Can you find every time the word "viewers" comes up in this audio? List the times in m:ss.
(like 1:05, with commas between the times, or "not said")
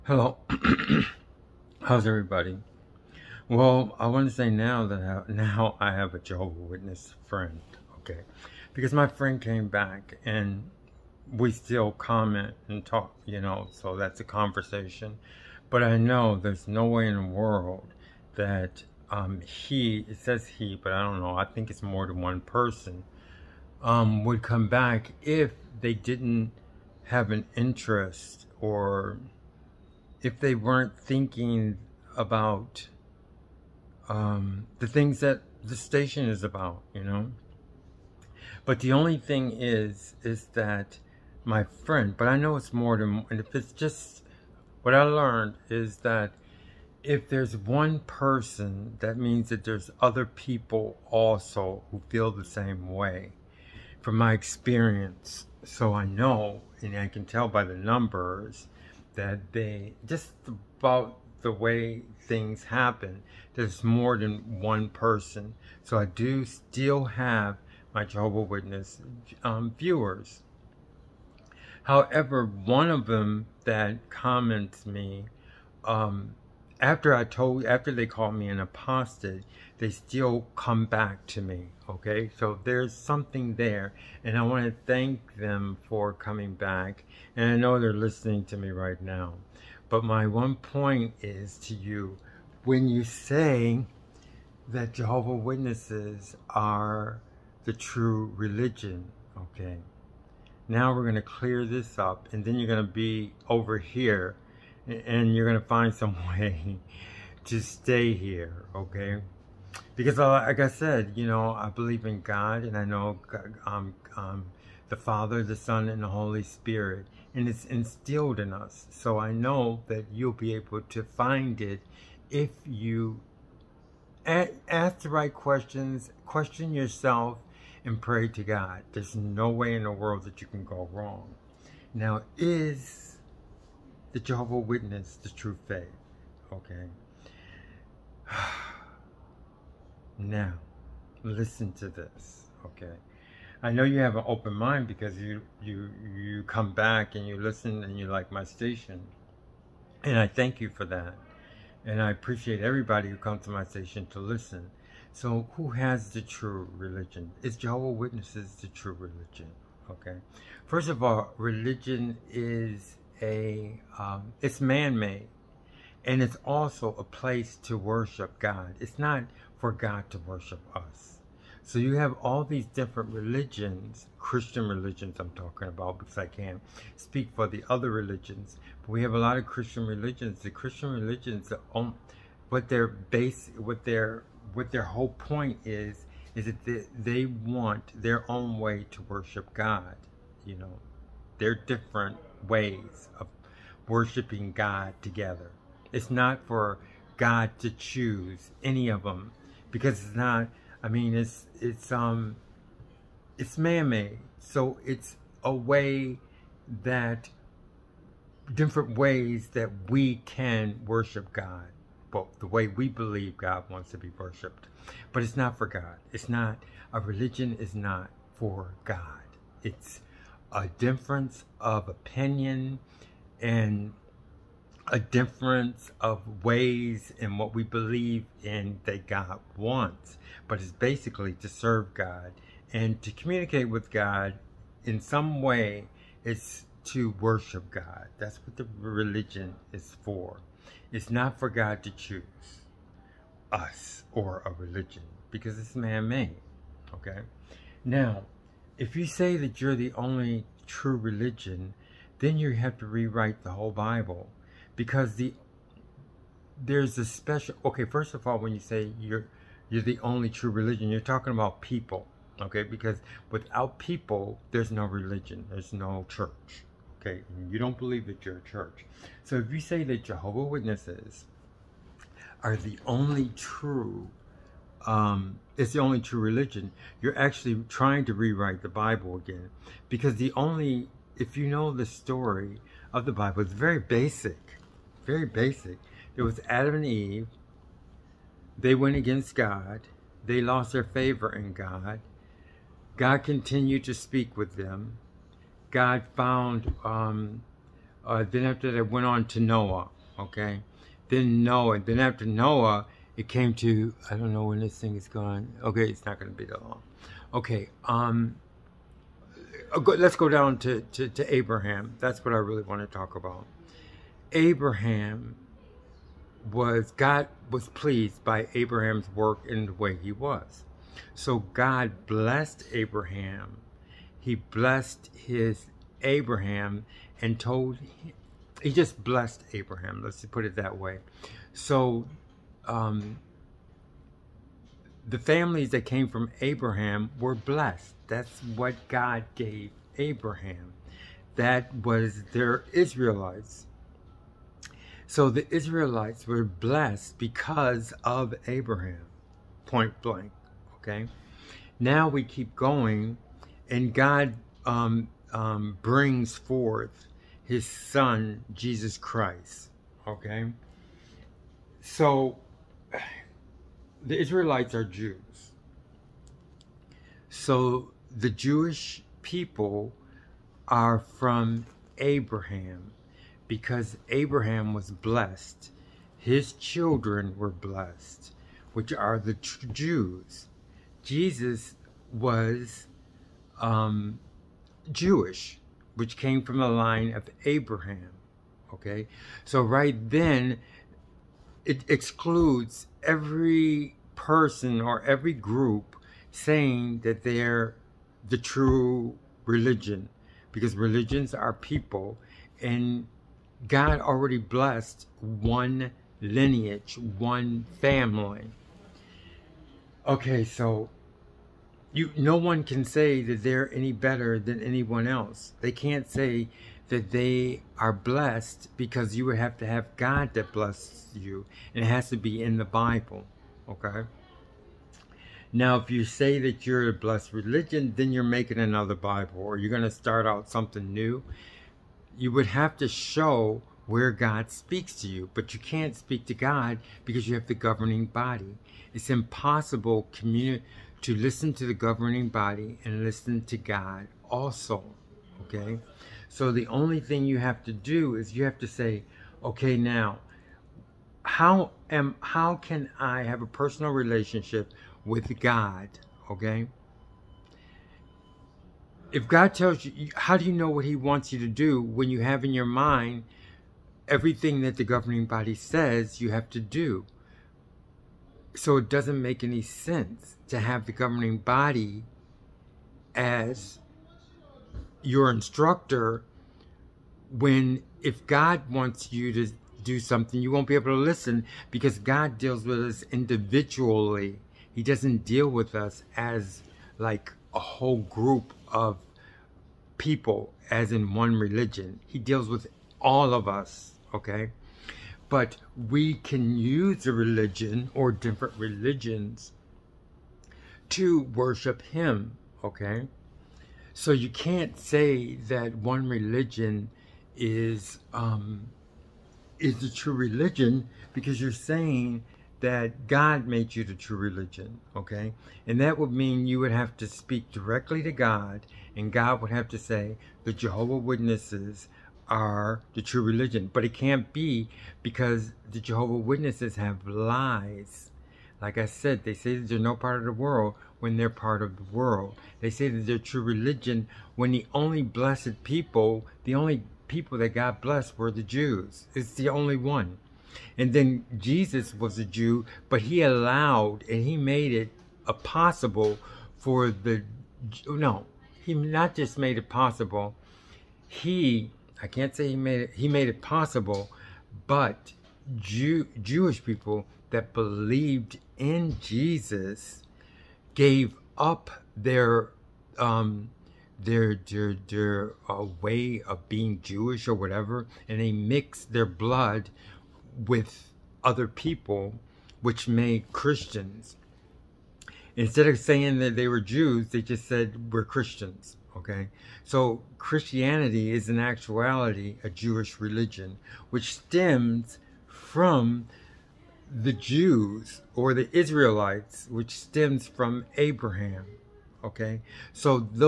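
1:09.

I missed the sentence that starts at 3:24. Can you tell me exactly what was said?
So it's a way that, different ways that we can worship God, but the way we believe God wants to be worshiped.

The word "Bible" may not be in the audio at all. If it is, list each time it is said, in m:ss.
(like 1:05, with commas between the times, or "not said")
4:13, 4:38, 4:43, 7:02, 7:08.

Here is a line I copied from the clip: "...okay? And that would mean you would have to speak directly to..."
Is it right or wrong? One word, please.
right.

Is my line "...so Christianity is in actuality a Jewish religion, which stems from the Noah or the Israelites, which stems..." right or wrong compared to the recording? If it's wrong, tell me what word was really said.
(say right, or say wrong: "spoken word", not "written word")
wrong: "Jews", not "Noah".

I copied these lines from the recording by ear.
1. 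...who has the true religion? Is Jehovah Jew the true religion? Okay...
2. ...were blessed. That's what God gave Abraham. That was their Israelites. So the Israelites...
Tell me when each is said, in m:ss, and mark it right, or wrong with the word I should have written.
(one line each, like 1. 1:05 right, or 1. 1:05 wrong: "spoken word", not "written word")
1. 2:35 wrong: "Witnesses", not "Jew"
2. 5:37 right.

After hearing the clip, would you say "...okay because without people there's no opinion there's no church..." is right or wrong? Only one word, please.
wrong.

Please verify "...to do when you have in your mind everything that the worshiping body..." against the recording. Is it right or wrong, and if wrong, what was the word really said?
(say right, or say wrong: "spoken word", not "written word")
wrong: "governing", not "worshiping".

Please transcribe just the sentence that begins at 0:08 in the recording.
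Because my friend came back and we still comment and talk, you know, so that's a conversation.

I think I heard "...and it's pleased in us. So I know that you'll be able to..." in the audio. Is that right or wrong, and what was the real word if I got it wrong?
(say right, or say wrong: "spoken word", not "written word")
wrong: "instilled", not "pleased".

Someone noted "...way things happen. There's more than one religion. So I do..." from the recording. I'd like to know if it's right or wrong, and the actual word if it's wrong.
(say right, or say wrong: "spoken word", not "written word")
wrong: "person", not "religion".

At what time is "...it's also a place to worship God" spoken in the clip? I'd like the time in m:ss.
2:46.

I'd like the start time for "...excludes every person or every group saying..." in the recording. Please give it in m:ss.
6:31.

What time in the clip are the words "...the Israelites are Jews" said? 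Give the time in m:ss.
6:04.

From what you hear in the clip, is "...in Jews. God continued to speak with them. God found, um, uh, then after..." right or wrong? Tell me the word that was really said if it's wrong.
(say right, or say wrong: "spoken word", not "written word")
wrong: "God", not "Jews".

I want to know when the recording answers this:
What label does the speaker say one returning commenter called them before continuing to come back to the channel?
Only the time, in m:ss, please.
1:18.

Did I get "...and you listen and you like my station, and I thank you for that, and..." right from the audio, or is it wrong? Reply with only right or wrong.
right.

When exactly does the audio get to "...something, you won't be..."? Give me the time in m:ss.
7:59.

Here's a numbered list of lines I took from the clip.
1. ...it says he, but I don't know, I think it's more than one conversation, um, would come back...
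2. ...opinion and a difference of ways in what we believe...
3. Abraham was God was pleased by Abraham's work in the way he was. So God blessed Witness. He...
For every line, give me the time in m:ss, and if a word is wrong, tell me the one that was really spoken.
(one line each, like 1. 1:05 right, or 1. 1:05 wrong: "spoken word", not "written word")
1. 0:20 wrong: "person", not "conversation"
2. 3:41 right
3. 5:14 wrong: "Abraham", not "Witness".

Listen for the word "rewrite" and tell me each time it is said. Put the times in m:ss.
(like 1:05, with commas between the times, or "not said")
4:12, 4:38.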